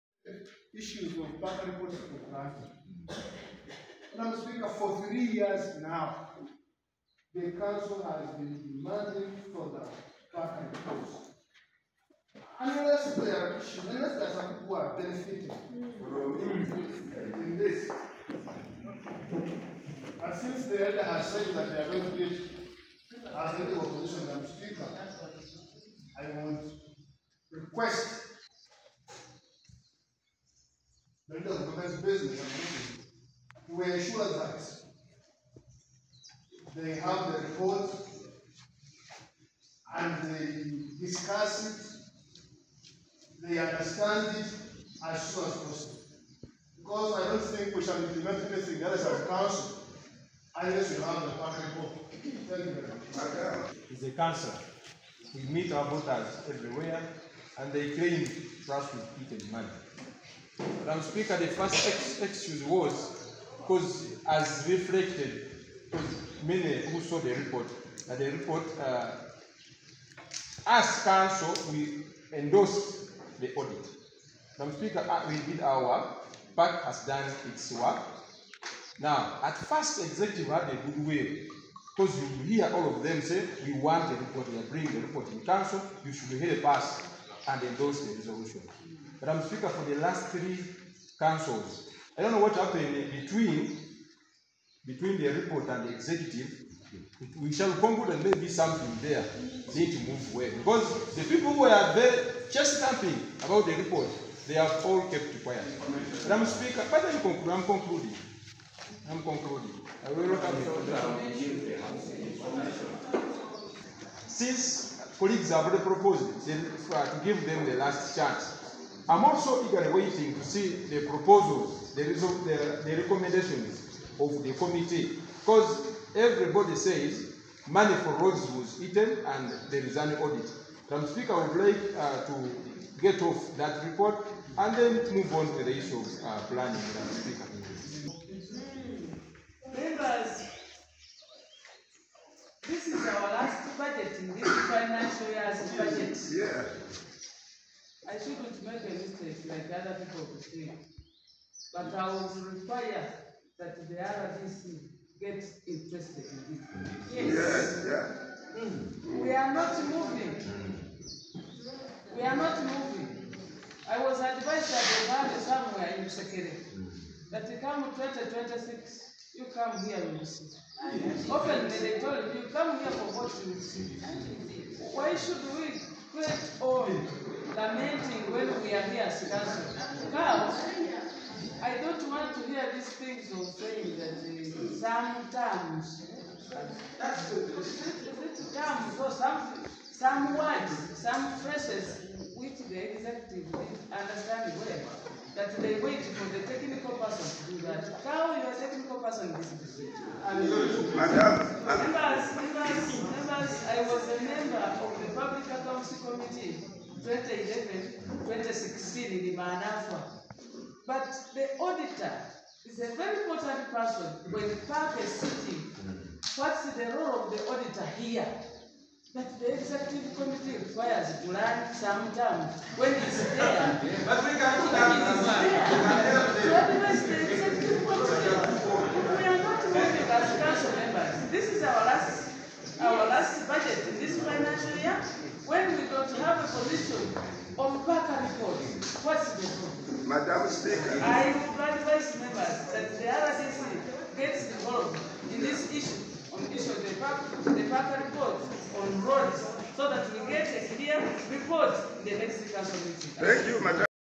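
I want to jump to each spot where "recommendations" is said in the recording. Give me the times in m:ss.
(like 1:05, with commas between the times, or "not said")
2:03.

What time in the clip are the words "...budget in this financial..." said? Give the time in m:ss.
2:23.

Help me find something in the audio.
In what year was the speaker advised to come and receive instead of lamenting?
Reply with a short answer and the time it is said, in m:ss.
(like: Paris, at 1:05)
2026, at 2:47.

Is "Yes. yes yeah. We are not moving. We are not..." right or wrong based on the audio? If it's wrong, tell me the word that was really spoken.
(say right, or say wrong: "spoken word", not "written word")
right.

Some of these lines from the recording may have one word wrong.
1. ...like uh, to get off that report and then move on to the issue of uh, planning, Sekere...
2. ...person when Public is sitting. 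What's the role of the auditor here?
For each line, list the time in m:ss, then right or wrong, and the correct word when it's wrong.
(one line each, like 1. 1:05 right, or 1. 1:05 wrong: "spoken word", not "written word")
1. 2:11 wrong: "Madam", not "Sekere"
2. 3:33 wrong: "PAC", not "Public".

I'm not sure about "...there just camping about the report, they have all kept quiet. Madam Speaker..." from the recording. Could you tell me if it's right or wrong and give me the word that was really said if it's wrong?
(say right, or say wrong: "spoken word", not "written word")
right.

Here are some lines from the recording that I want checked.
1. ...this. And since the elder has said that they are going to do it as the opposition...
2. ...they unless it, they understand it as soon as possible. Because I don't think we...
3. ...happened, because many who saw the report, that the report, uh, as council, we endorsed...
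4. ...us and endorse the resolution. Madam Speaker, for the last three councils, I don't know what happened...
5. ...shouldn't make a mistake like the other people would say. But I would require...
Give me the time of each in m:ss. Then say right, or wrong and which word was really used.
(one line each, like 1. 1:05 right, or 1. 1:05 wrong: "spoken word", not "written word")
1. 0:17 right
2. 0:40 wrong: "discuss", not "unless"
3. 1:04 wrong: "reflected", not "happened"
4. 1:26 right
5. 2:28 right.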